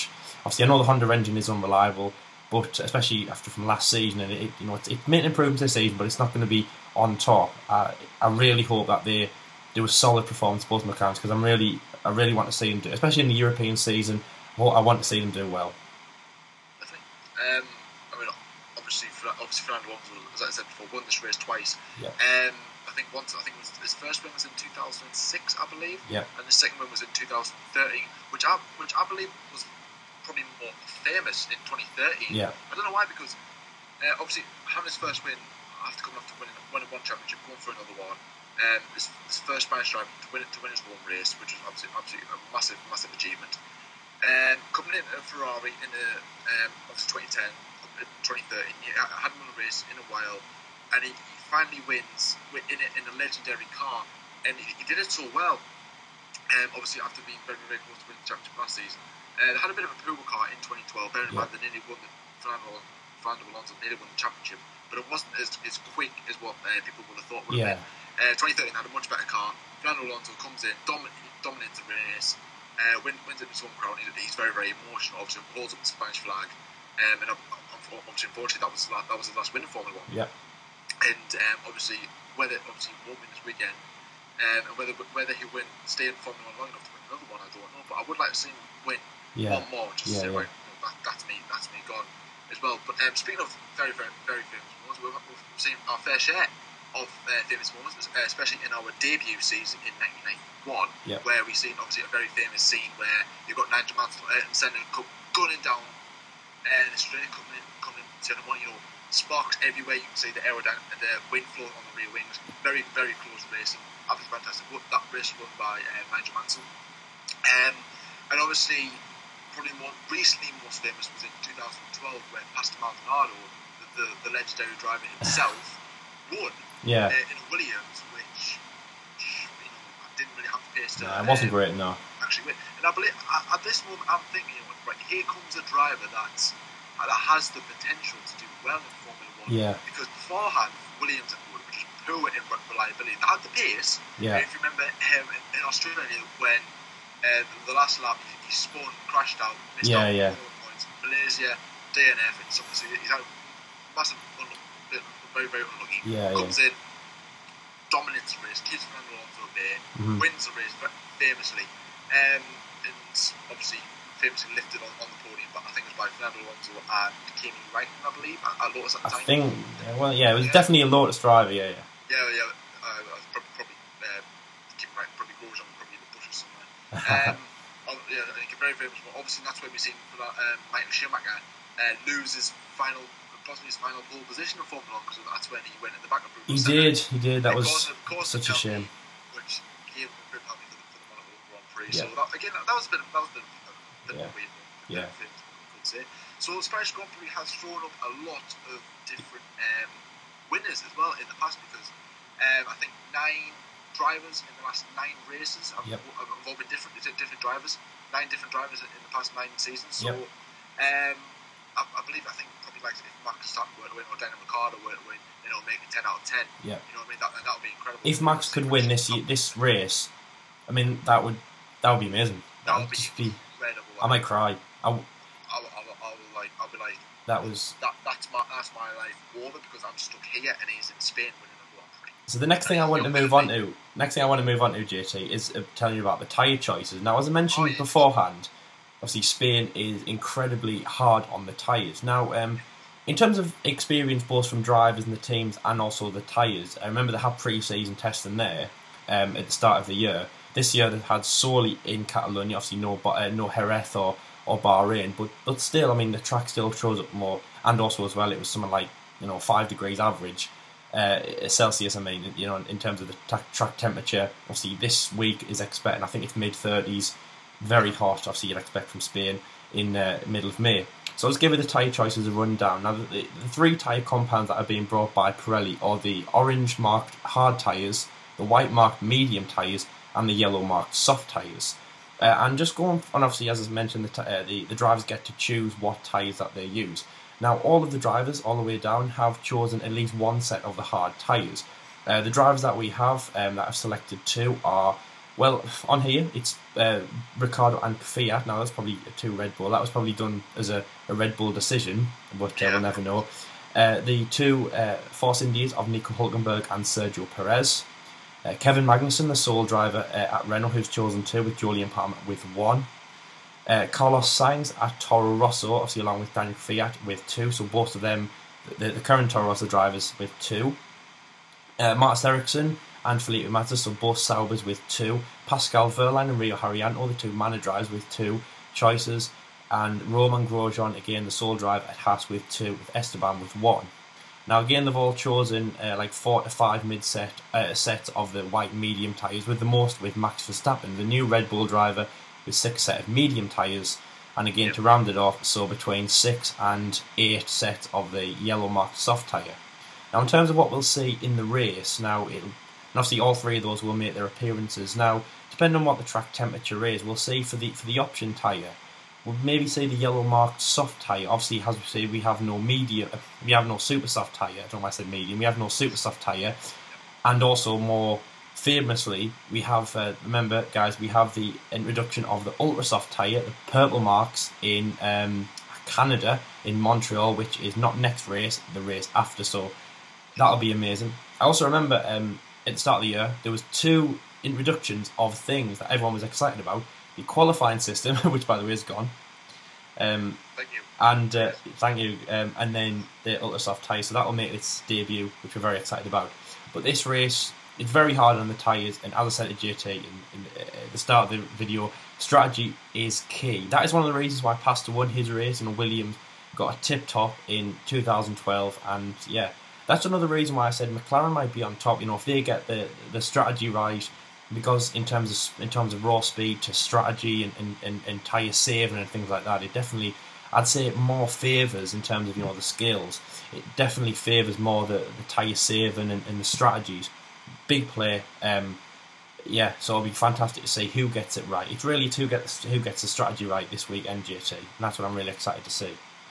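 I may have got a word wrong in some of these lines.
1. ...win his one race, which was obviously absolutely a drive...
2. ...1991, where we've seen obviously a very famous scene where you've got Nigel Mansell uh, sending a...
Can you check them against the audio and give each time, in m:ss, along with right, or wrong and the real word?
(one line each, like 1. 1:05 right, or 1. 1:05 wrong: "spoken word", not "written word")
1. 0:40 wrong: "massive", not "drive"
2. 1:40 right.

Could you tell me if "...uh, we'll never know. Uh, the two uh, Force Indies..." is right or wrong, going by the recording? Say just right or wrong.
right.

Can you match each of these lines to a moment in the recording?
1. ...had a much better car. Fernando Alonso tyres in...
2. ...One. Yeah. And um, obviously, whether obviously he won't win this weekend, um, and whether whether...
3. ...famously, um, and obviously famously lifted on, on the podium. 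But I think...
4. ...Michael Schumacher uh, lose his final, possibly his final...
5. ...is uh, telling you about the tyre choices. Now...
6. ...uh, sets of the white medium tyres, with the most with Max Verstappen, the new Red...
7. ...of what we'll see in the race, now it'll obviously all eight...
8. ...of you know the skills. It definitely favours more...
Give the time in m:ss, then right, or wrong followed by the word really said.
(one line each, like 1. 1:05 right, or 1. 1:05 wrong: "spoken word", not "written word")
1. 1:08 wrong: "comes", not "tyres"
2. 1:19 right
3. 2:41 right
4. 3:00 right
5. 3:55 right
6. 5:37 right
7. 5:50 wrong: "three", not "eight"
8. 7:02 right.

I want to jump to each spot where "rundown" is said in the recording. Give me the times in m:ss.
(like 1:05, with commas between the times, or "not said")
4:32.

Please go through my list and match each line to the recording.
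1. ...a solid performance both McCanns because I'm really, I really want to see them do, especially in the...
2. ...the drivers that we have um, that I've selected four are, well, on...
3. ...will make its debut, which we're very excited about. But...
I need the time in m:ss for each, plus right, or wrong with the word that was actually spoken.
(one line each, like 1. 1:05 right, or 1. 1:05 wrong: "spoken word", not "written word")
1. 0:09 right
2. 4:52 wrong: "two", not "four"
3. 6:34 right.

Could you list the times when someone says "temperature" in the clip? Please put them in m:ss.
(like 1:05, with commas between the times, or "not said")
4:23, 5:56.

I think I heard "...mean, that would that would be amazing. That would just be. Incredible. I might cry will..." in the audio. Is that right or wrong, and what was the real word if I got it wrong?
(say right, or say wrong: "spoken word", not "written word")
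right.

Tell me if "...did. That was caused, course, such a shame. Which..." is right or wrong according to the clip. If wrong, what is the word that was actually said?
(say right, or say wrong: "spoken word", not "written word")
right.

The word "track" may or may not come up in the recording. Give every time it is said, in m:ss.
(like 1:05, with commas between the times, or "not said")
4:16, 4:23, 5:56.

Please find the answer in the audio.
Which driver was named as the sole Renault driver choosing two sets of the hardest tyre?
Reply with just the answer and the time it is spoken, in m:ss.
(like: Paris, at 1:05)
Kevin Magnussen, at 5:08.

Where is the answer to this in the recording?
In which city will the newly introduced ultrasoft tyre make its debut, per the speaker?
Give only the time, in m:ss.
6:16.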